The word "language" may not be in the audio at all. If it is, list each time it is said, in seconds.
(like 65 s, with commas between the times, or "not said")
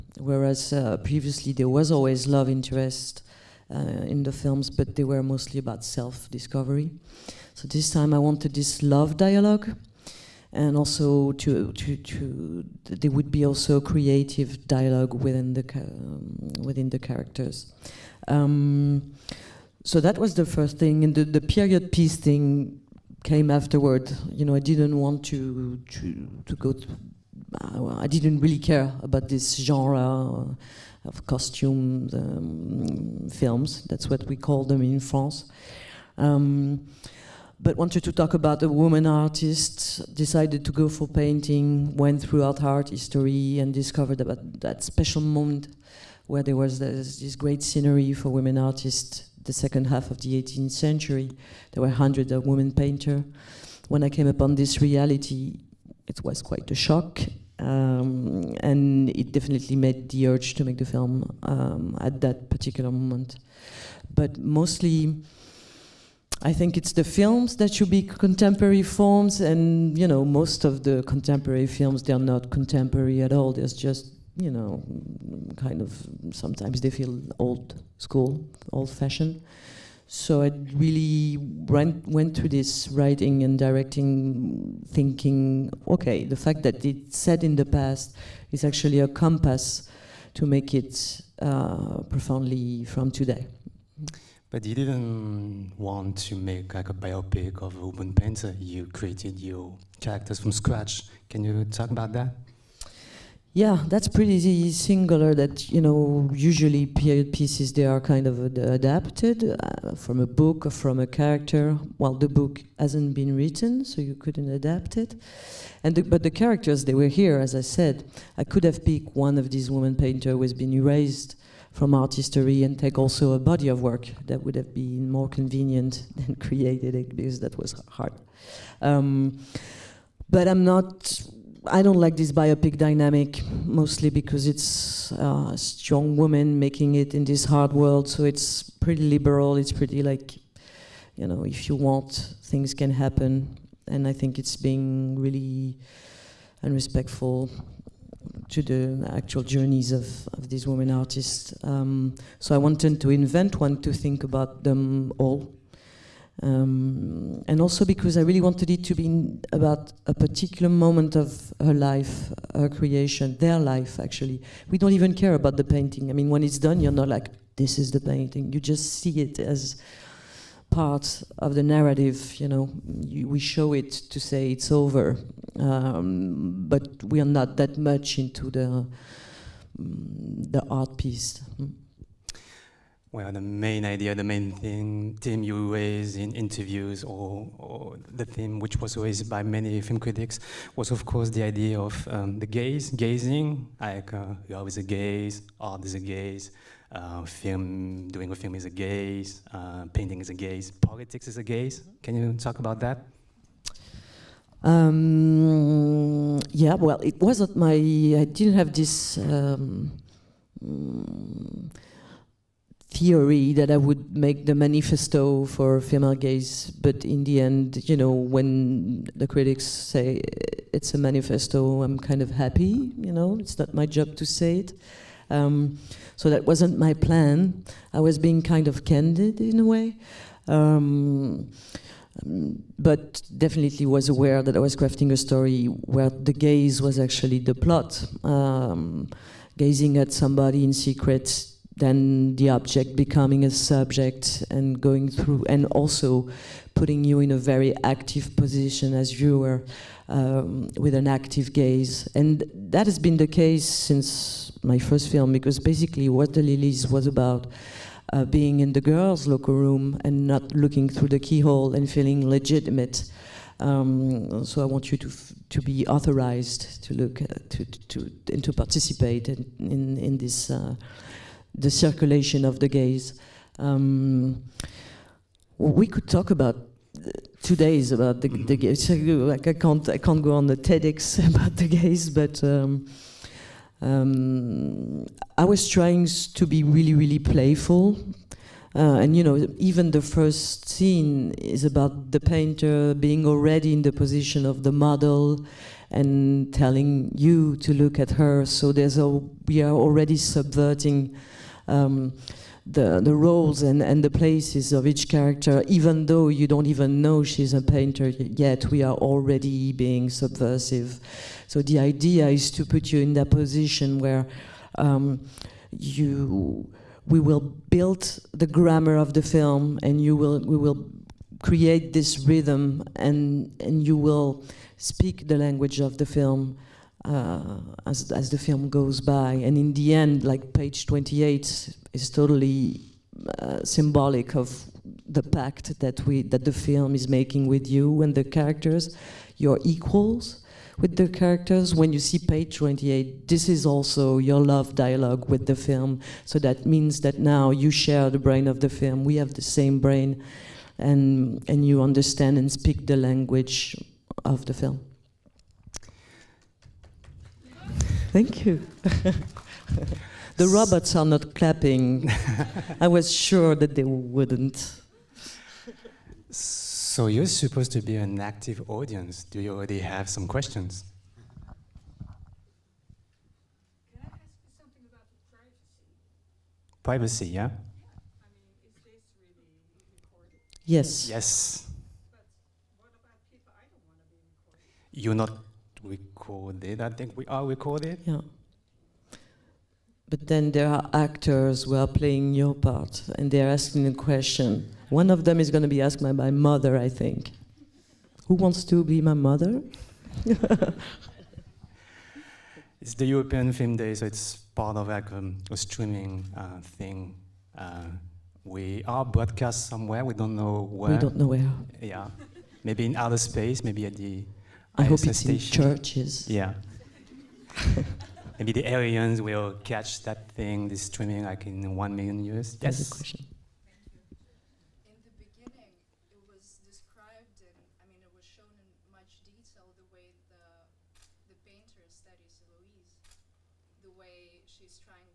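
325 s, 352 s.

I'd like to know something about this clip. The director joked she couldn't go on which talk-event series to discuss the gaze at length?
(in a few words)
TEDx.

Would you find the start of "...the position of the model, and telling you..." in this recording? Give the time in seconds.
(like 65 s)
293 s.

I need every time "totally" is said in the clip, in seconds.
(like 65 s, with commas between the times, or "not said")
332 s.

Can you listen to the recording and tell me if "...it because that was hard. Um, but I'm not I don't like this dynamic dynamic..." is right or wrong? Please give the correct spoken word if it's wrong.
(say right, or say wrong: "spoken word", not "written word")
wrong: "biopic", not "dynamic".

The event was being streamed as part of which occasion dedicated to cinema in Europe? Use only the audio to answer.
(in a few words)
European Film Day.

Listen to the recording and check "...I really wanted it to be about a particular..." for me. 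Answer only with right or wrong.
right.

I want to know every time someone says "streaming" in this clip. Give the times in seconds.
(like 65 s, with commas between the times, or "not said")
405 s, 420 s.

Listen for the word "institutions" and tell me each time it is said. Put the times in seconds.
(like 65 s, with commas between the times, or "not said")
not said.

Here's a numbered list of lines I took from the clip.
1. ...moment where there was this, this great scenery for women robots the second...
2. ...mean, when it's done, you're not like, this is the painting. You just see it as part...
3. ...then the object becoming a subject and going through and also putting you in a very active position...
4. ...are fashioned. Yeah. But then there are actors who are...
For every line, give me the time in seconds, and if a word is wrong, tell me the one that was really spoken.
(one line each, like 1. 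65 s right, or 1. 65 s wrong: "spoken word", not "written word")
1. 45 s wrong: "artists", not "robots"
2. 166 s right
3. 241 s right
4. 387 s wrong: "recorded", not "fashioned".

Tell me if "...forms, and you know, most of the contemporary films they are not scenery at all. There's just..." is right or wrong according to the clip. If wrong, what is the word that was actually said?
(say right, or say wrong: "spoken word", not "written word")
wrong: "contemporary", not "scenery".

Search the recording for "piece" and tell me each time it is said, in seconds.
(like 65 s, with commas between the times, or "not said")
21 s, 107 s, 180 s.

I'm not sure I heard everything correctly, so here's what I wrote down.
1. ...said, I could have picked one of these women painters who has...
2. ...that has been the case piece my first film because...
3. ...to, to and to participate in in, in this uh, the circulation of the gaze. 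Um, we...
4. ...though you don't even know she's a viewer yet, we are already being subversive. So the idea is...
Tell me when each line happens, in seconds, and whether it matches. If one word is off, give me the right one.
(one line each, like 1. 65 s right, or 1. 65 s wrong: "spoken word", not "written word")
1. 117 s right
2. 252 s wrong: "since", not "piece"
3. 267 s right
4. 306 s wrong: "painter", not "viewer".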